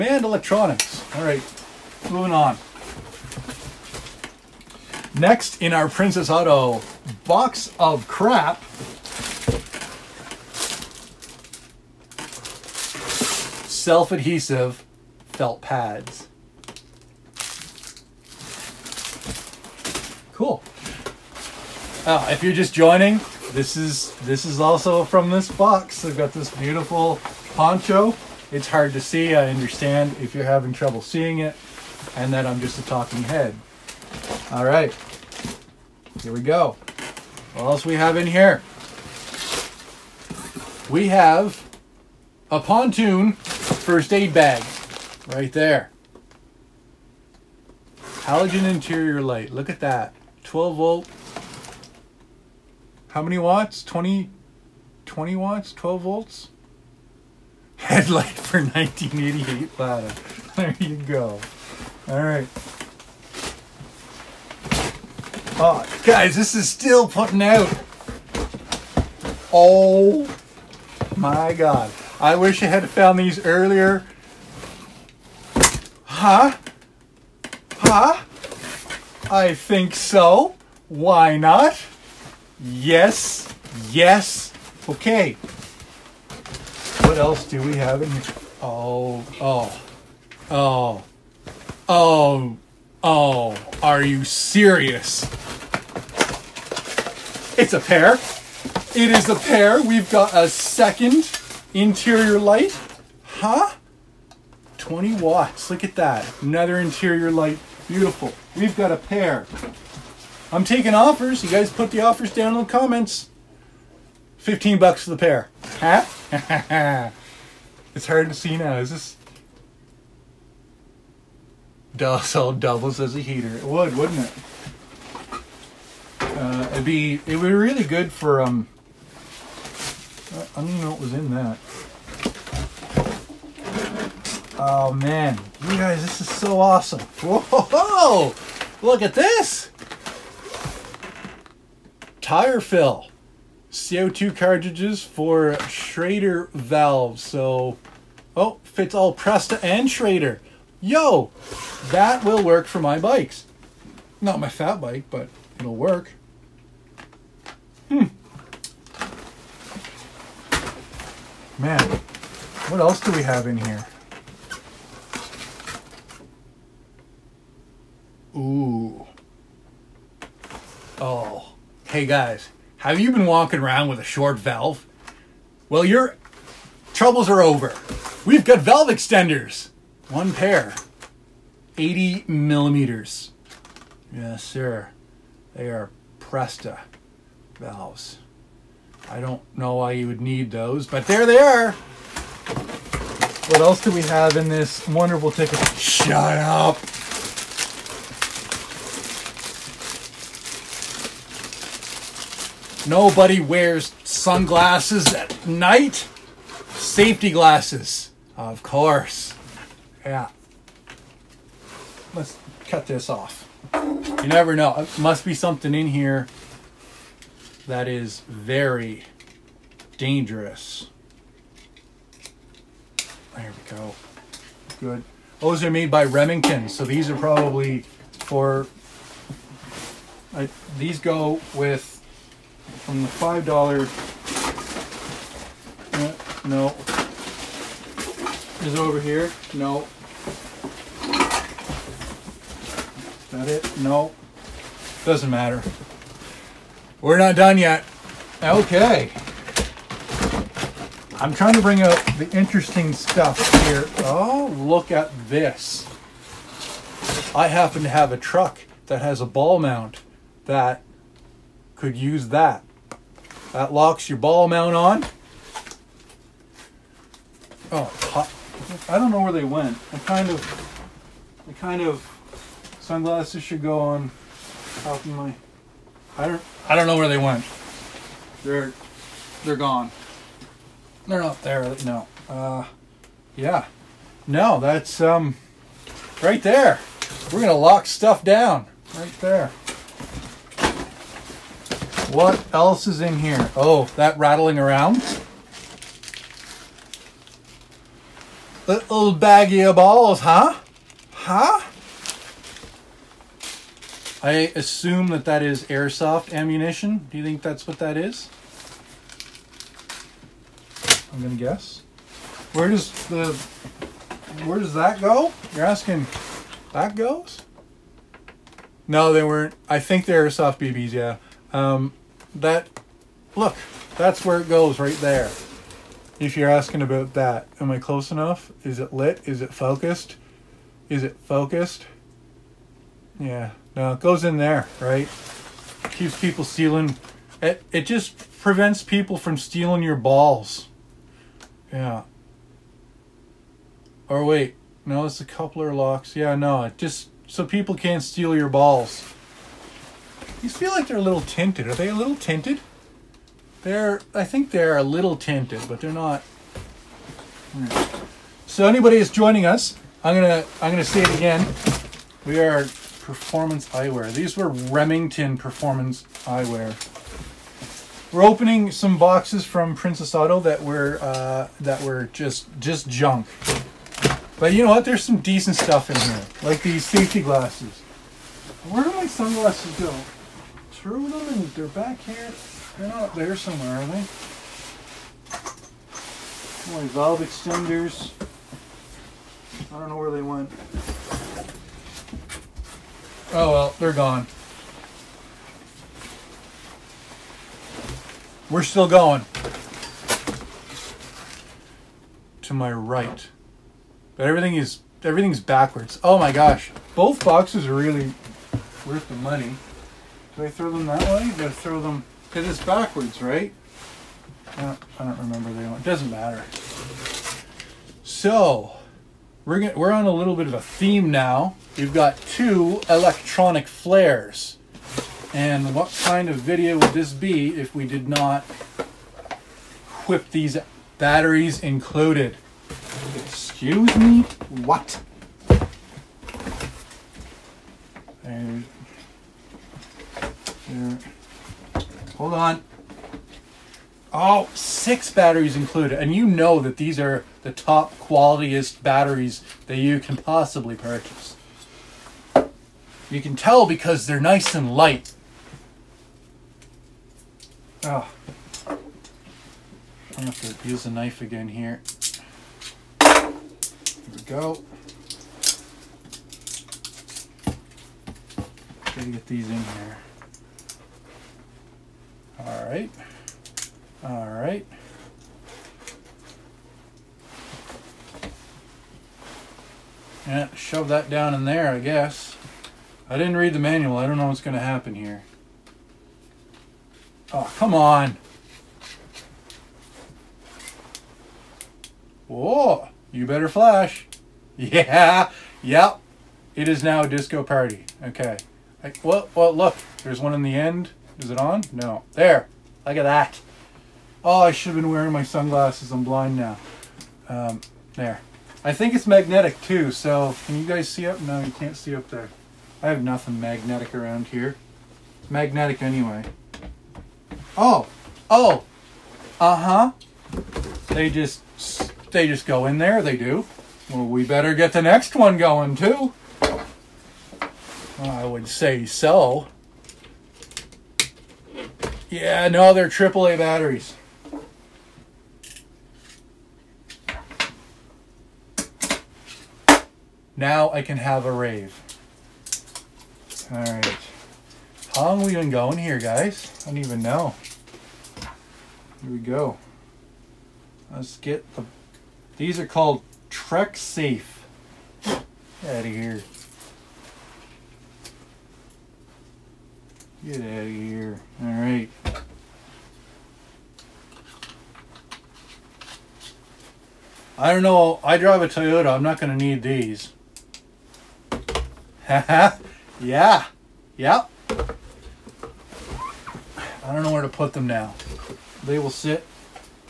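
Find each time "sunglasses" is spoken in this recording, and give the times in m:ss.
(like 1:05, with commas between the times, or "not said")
3:24, 4:32, 6:19, 8:25.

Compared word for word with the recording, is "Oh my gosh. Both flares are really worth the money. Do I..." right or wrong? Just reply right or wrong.
wrong.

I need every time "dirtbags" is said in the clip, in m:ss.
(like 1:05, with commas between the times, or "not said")
not said.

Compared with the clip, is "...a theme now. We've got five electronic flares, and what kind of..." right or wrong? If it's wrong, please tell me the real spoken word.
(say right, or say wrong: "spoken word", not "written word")
wrong: "two", not "five".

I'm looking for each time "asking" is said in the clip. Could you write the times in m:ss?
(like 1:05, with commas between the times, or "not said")
5:15, 5:26.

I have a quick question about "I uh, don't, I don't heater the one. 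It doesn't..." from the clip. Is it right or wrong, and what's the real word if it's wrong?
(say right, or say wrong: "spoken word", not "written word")
wrong: "remember", not "heater".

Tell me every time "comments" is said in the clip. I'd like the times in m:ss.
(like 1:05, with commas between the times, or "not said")
1:52.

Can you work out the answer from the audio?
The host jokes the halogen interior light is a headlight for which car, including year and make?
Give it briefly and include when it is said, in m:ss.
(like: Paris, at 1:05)
1988 Lada, at 0:58.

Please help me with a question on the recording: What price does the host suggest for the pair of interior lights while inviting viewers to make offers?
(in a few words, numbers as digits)
15 bucks.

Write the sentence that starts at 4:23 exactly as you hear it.
That locks your ball mount on.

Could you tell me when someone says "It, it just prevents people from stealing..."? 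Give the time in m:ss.
5:37.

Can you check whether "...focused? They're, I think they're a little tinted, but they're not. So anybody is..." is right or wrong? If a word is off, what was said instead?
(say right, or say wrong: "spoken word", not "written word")
wrong: "tinted", not "focused".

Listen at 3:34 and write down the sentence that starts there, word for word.
It must be something in here that is very dangerous.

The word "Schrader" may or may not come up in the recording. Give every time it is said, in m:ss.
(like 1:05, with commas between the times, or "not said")
2:25, 2:29.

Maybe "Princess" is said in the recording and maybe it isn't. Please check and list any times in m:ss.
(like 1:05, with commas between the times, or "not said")
0:05, 6:09.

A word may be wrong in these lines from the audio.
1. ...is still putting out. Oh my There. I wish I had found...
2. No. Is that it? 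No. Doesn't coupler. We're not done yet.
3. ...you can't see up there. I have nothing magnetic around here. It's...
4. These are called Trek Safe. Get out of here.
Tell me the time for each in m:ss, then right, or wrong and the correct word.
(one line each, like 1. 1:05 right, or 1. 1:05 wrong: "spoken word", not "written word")
1. 1:06 wrong: "God", not "There"
2. 3:59 wrong: "matter", not "coupler"
3. 8:31 right
4. 9:12 right.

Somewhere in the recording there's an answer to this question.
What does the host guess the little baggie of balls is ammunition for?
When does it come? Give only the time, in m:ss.
5:05.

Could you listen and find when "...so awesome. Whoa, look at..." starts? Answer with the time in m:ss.
2:16.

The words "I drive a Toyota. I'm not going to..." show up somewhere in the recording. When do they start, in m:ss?
9:28.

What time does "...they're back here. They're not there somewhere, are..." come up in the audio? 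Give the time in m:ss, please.
6:21.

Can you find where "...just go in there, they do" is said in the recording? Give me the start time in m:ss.
8:42.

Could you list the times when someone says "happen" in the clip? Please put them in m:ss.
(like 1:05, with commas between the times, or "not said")
4:17, 8:04.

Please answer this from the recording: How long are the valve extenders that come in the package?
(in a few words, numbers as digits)
80 millimeters.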